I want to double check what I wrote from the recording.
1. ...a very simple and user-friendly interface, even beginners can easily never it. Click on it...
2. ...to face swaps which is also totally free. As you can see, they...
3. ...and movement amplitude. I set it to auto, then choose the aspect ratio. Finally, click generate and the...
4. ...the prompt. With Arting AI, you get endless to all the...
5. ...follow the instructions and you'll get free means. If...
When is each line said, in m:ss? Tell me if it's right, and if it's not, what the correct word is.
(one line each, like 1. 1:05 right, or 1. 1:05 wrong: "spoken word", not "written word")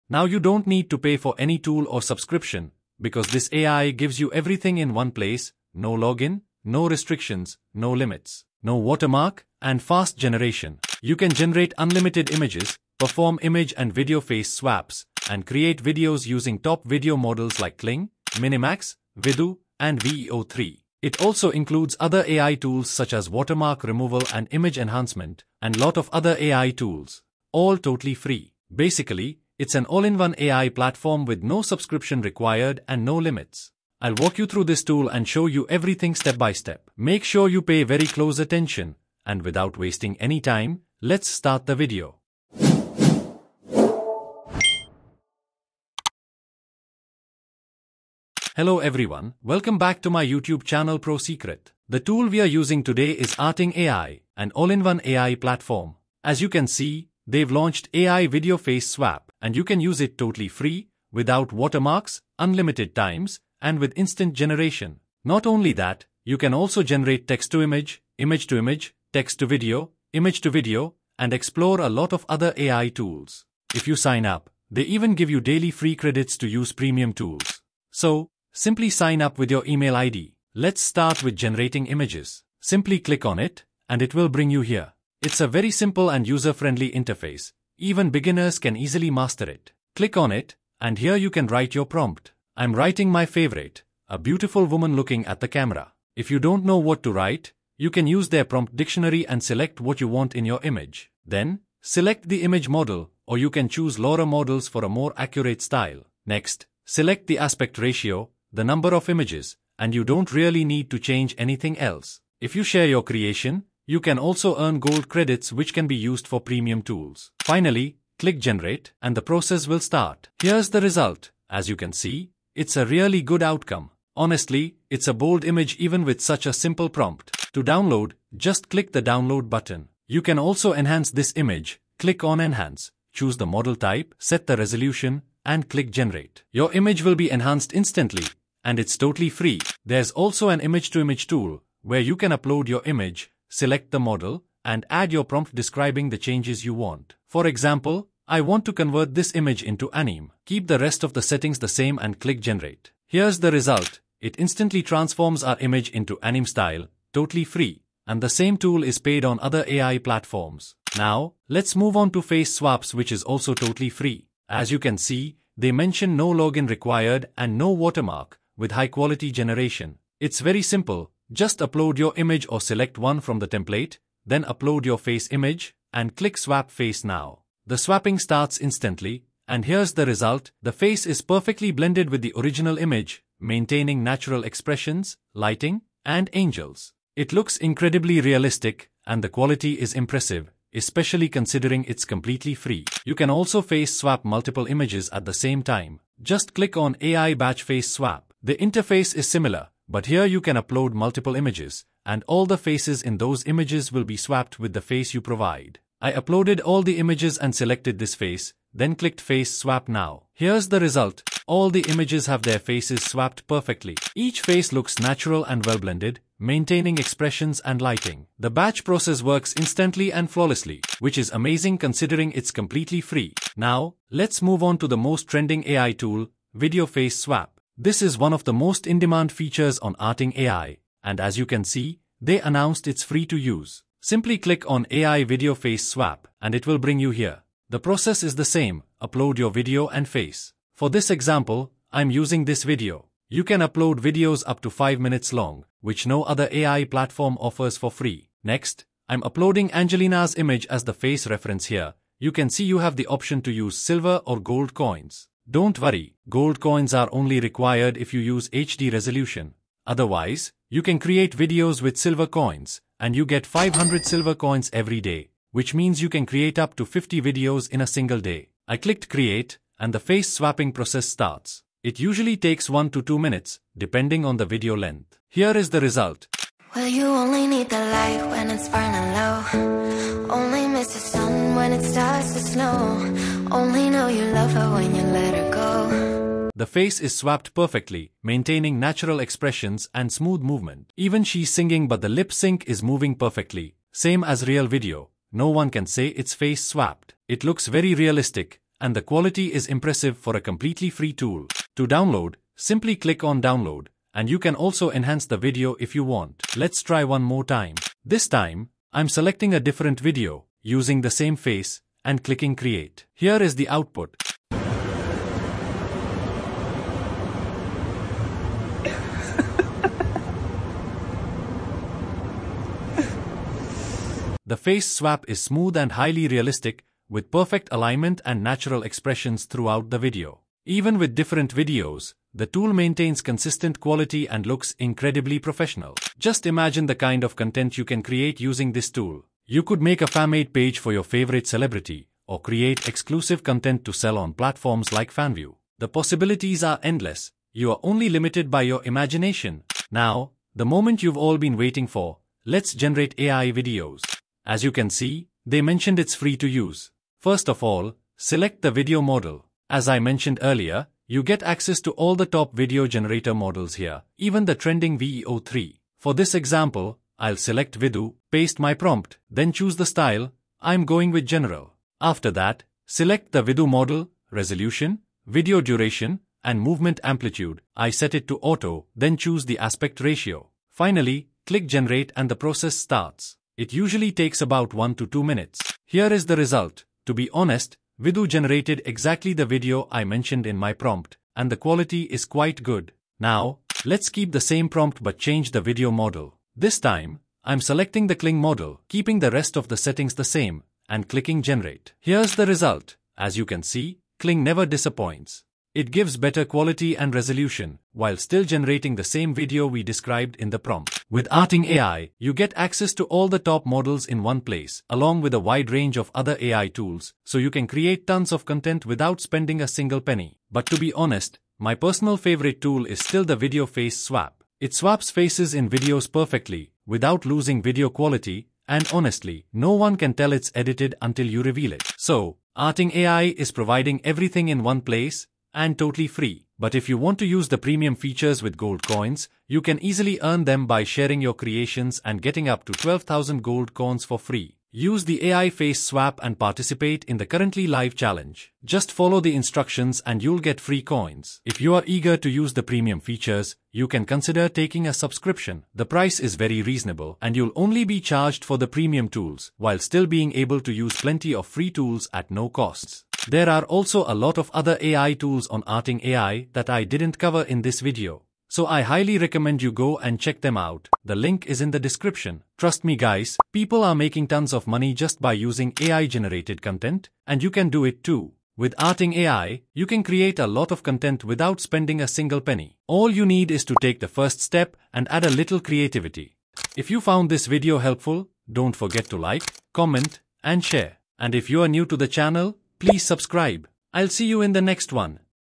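1. 1:25 wrong: "master", not "never"
2. 2:42 right
3. 6:16 right
4. 6:50 wrong: "access", not "endless"
5. 7:28 wrong: "coins", not "means".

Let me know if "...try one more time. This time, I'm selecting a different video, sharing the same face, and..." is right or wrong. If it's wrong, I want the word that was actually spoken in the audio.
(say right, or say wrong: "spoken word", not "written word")
wrong: "using", not "sharing".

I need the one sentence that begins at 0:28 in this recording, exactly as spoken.
Basically, it's an all-in-one AI platform with no subscription required and no limits.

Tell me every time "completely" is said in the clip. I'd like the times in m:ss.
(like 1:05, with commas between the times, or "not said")
3:12, 3:42, 5:00.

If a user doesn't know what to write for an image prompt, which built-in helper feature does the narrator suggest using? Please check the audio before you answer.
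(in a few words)
Prompt dictionary.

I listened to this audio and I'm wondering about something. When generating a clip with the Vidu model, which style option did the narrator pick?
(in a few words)
General.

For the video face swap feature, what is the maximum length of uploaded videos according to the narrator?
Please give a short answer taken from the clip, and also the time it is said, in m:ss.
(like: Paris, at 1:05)
5 minutes, at 4:04.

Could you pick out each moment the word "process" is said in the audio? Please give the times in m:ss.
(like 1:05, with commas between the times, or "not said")
1:59, 3:38, 3:57, 4:30, 6:22.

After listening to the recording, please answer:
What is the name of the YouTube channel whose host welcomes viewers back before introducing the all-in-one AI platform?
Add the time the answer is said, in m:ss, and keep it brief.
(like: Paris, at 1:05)
ProSecret, at 0:50.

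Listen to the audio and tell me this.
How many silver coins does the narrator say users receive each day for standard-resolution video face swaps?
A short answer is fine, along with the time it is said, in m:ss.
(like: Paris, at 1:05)
500, at 4:23.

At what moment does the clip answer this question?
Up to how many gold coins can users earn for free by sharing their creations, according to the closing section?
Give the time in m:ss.
7:22.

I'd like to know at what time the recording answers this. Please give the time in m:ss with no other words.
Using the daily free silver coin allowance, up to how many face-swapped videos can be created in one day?
4:26.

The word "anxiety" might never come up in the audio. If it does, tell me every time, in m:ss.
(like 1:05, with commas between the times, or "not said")
not said.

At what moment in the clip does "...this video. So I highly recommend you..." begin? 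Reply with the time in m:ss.
7:47.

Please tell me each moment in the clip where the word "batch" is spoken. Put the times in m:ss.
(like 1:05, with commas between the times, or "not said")
3:17, 3:38.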